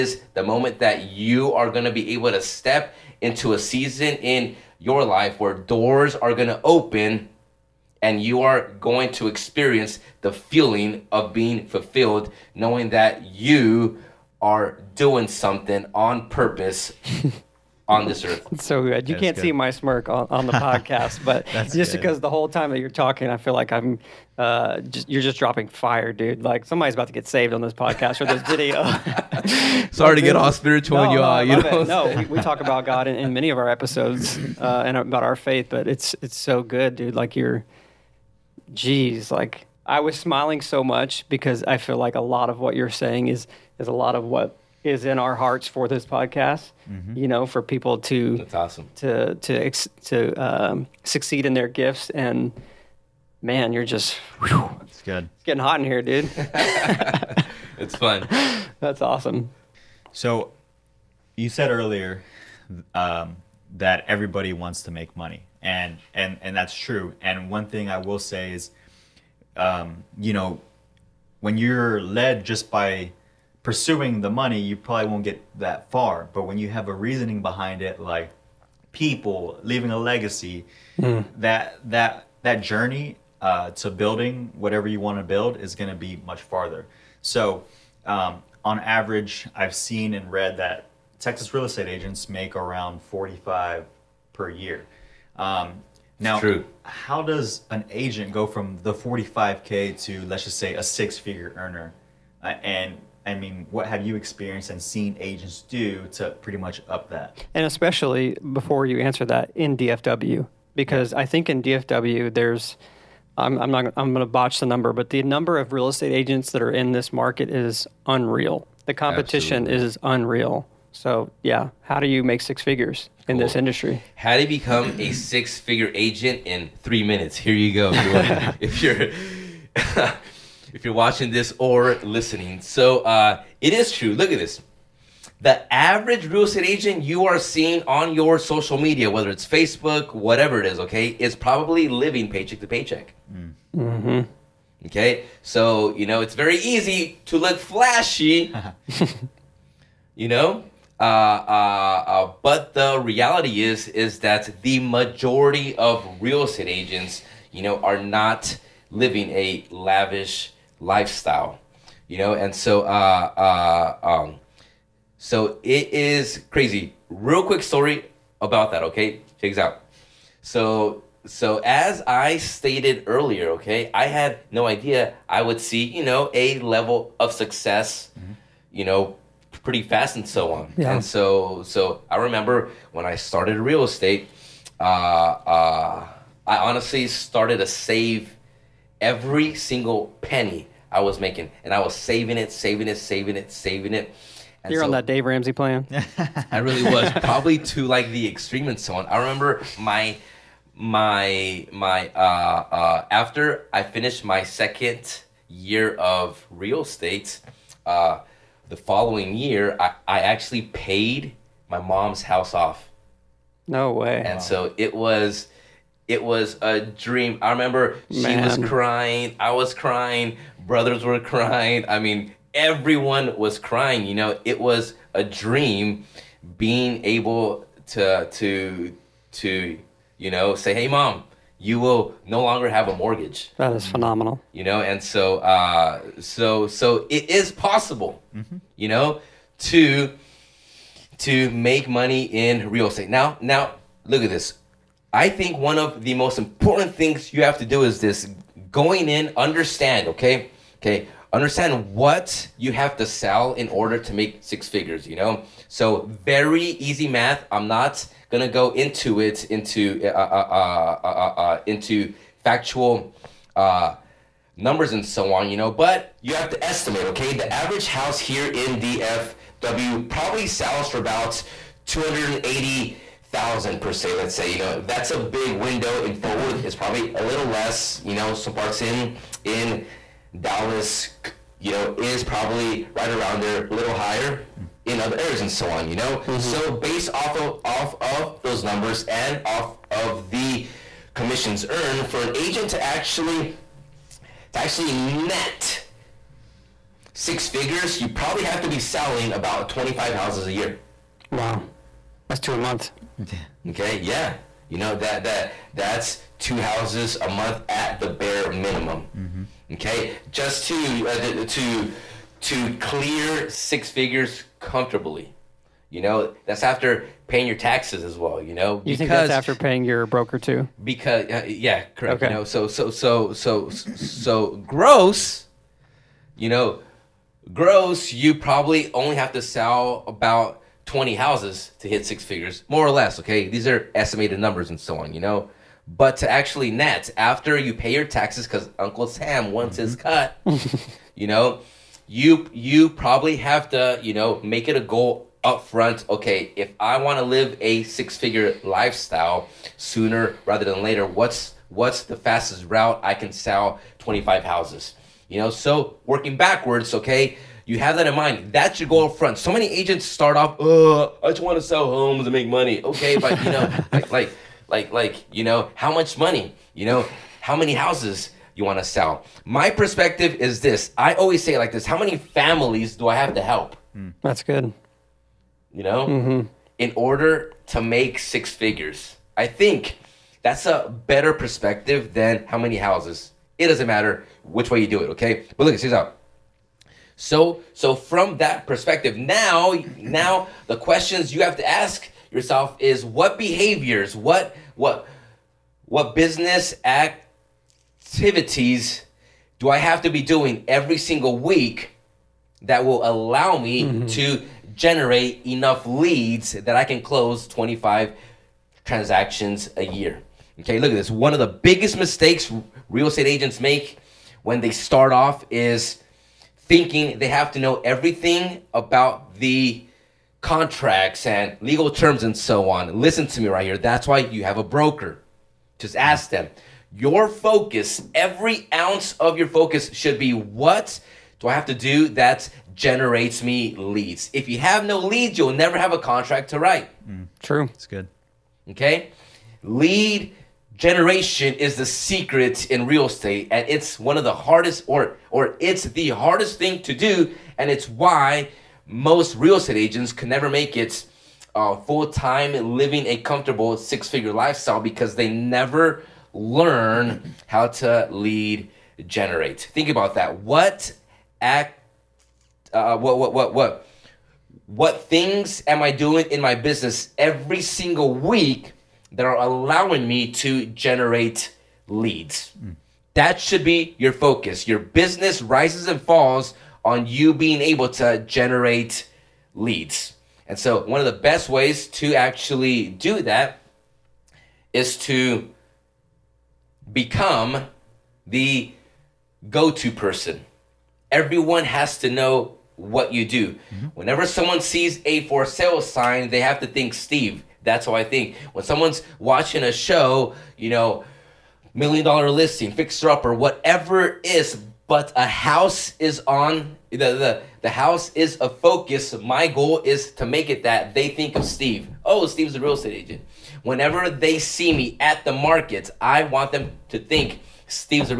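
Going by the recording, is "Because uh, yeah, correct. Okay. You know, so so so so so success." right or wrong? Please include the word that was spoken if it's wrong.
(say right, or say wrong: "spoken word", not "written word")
wrong: "gross", not "success".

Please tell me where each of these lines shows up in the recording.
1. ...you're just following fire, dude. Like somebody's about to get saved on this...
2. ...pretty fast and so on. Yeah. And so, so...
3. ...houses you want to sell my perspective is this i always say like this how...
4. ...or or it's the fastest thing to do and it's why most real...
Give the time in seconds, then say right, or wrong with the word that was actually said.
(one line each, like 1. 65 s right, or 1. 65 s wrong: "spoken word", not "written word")
1. 25 s wrong: "dropping", not "following"
2. 179 s right
3. 367 s right
4. 444 s wrong: "hardest", not "fastest".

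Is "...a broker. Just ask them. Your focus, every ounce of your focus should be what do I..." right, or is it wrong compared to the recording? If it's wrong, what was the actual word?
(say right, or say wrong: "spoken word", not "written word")
right.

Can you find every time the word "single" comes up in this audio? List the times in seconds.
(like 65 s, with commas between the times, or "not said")
189 s, 400 s, 467 s.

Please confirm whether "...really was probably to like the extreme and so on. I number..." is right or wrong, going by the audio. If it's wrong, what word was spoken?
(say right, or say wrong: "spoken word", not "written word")
wrong: "remember", not "number".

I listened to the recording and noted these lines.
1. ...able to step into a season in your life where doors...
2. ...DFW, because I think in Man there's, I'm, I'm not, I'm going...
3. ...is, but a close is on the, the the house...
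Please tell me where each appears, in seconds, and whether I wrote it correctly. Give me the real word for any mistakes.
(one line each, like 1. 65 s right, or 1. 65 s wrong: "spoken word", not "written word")
1. 2 s right
2. 109 s wrong: "DFW", not "Man"
3. 504 s wrong: "house", not "close".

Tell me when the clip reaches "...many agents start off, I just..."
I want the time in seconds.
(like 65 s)
359 s.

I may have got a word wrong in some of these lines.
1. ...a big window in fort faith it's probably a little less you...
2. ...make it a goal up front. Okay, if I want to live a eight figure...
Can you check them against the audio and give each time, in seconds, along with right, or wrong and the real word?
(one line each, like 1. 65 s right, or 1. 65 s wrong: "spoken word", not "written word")
1. 275 s wrong: "worth", not "faith"
2. 344 s wrong: "six", not "eight".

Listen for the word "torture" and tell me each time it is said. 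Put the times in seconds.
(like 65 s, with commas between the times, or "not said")
not said.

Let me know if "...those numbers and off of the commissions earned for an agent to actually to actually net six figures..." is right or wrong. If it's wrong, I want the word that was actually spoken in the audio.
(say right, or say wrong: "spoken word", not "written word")
right.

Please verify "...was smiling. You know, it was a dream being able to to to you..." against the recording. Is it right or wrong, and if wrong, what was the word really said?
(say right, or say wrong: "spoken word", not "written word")
wrong: "crying", not "smiling".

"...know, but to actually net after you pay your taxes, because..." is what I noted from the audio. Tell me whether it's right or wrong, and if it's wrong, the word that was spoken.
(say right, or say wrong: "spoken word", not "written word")
right.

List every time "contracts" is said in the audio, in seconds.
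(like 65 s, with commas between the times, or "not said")
420 s, 435 s.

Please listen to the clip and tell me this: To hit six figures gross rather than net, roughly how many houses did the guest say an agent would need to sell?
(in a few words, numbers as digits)
20.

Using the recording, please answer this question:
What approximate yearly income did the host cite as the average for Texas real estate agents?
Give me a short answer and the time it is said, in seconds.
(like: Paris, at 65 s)
45 thousand, at 93 s.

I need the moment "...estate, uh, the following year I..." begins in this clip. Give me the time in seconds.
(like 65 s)
206 s.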